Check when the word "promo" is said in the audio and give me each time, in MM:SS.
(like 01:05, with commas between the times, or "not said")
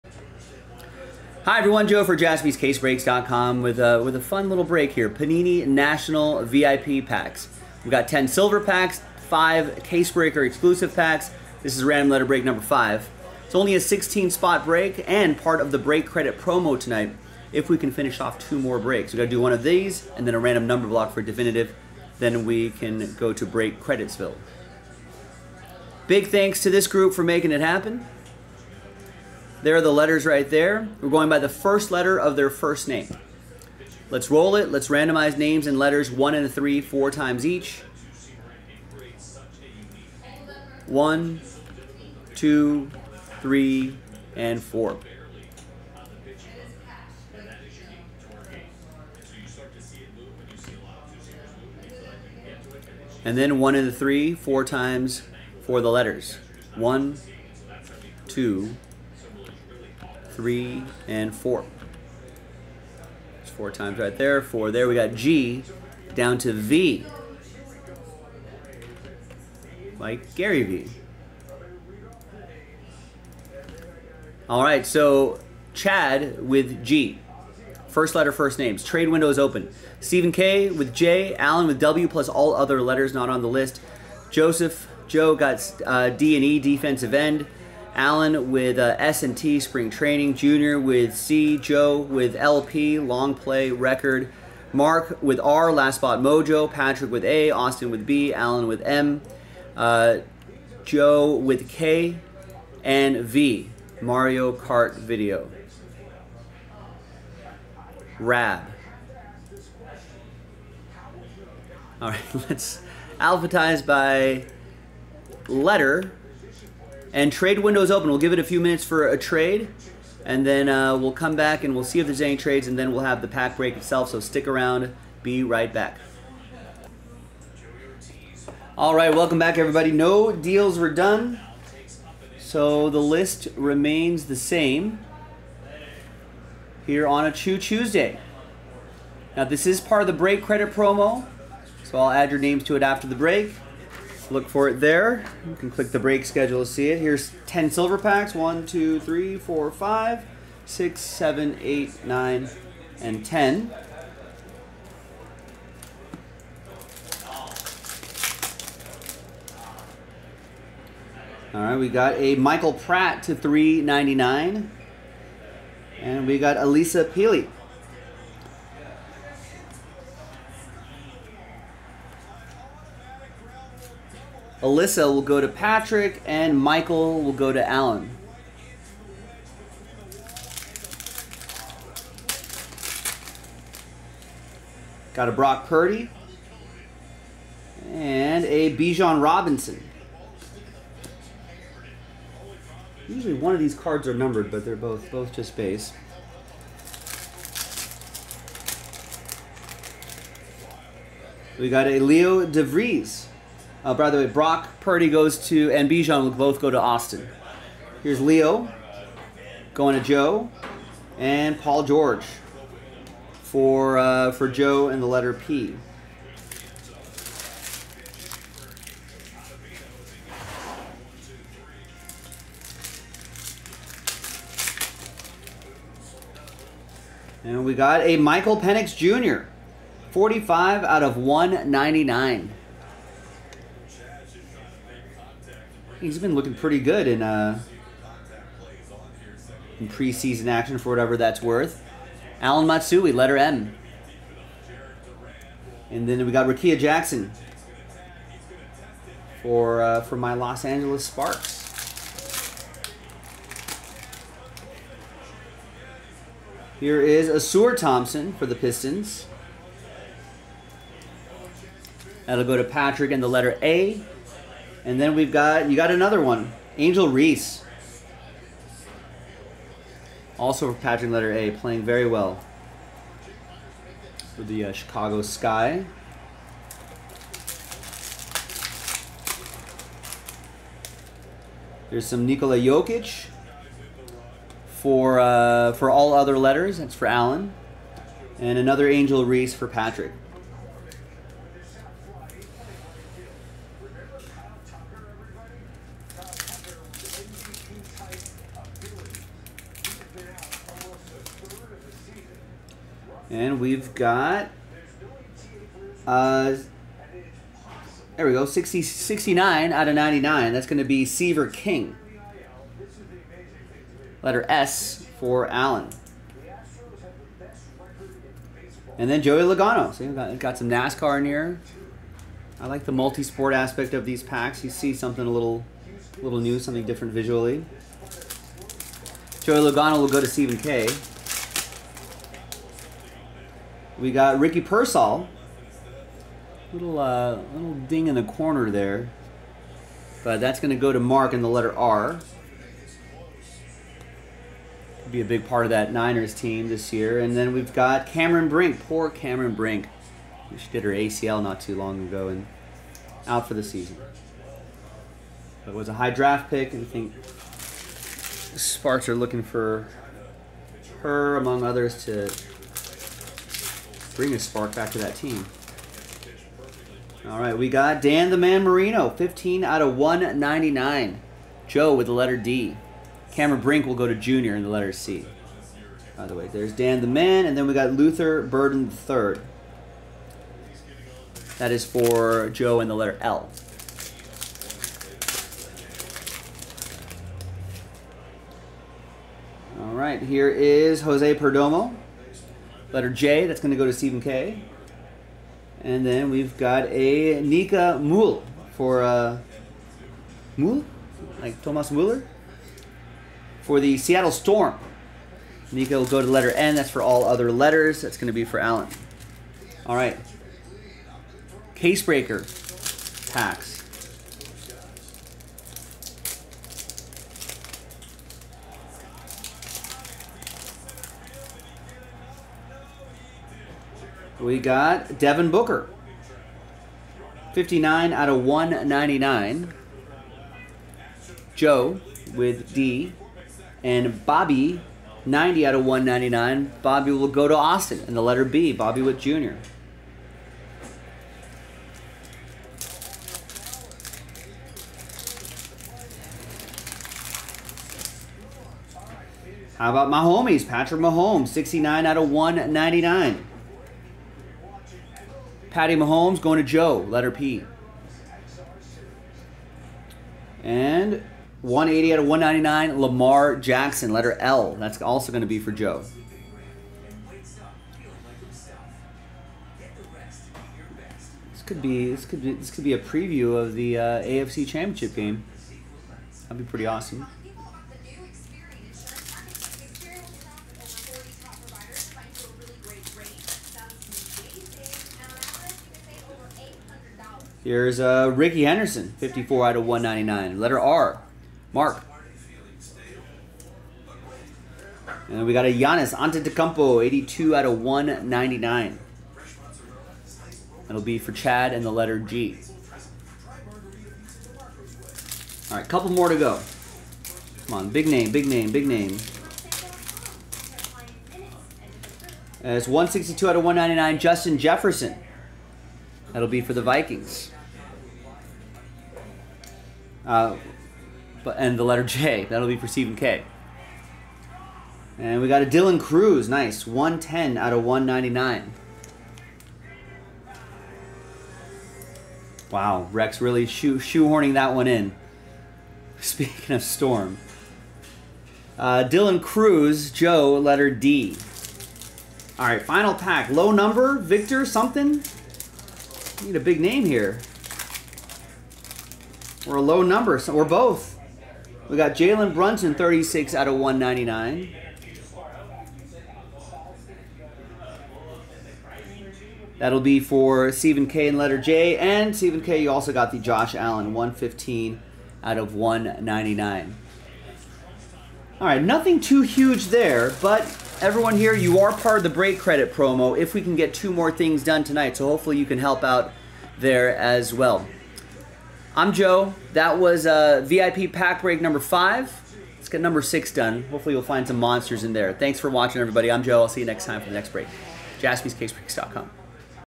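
00:16, 02:20, 09:32.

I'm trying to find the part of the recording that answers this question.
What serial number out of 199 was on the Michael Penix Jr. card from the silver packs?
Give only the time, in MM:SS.
03:50.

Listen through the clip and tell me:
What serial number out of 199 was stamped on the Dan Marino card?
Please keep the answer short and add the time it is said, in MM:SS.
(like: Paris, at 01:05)
15, at 06:09.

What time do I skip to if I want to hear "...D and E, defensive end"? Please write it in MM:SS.
01:26.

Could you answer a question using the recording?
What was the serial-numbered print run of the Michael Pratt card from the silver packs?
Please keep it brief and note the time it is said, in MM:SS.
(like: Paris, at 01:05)
399, at 02:43.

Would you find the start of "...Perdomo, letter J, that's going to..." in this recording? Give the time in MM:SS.
06:31.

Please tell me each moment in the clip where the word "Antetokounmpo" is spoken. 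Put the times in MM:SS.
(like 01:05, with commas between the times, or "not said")
08:16.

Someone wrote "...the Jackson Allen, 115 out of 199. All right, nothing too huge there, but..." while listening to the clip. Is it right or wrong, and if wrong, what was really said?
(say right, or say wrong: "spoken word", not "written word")
wrong: "Josh", not "Jackson".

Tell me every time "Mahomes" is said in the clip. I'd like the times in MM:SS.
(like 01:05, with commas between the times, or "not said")
07:30, 07:35.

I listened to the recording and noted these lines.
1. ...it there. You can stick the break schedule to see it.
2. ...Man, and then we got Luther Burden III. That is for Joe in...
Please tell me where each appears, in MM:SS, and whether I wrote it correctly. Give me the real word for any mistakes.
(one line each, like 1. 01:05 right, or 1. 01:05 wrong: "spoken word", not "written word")
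1. 02:24 wrong: "click", not "stick"
2. 06:17 right.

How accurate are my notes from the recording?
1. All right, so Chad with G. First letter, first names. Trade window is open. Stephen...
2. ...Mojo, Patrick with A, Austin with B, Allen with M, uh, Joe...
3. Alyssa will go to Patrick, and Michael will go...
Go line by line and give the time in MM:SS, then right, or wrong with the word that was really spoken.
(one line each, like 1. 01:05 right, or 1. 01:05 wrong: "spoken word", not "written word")
1. 01:14 right
2. 01:36 right
3. 02:54 right.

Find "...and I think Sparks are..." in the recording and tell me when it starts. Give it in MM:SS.
05:56.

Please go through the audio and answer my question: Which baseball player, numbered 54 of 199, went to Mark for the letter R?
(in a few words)
Rickey Henderson.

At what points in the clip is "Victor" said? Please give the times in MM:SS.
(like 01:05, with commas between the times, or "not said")
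09:04.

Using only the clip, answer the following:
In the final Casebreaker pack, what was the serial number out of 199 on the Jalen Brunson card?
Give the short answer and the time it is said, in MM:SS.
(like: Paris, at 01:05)
36, at 09:12.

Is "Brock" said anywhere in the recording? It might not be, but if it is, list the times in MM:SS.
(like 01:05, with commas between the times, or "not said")
03:05, 03:24.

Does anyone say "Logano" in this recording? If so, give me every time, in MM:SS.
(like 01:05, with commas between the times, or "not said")
05:19, 05:29.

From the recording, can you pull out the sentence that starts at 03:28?
Here's Leo going to Joe, and Paul George for uh, for Joe and the letter P.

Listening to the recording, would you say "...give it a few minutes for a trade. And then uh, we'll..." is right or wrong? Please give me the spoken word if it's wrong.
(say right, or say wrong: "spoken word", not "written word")
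right.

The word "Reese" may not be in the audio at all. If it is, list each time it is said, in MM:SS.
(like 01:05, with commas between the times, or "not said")
04:27, 04:49.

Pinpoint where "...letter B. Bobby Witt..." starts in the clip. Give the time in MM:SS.
07:18.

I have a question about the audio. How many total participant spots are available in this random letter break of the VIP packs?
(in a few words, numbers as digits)
16.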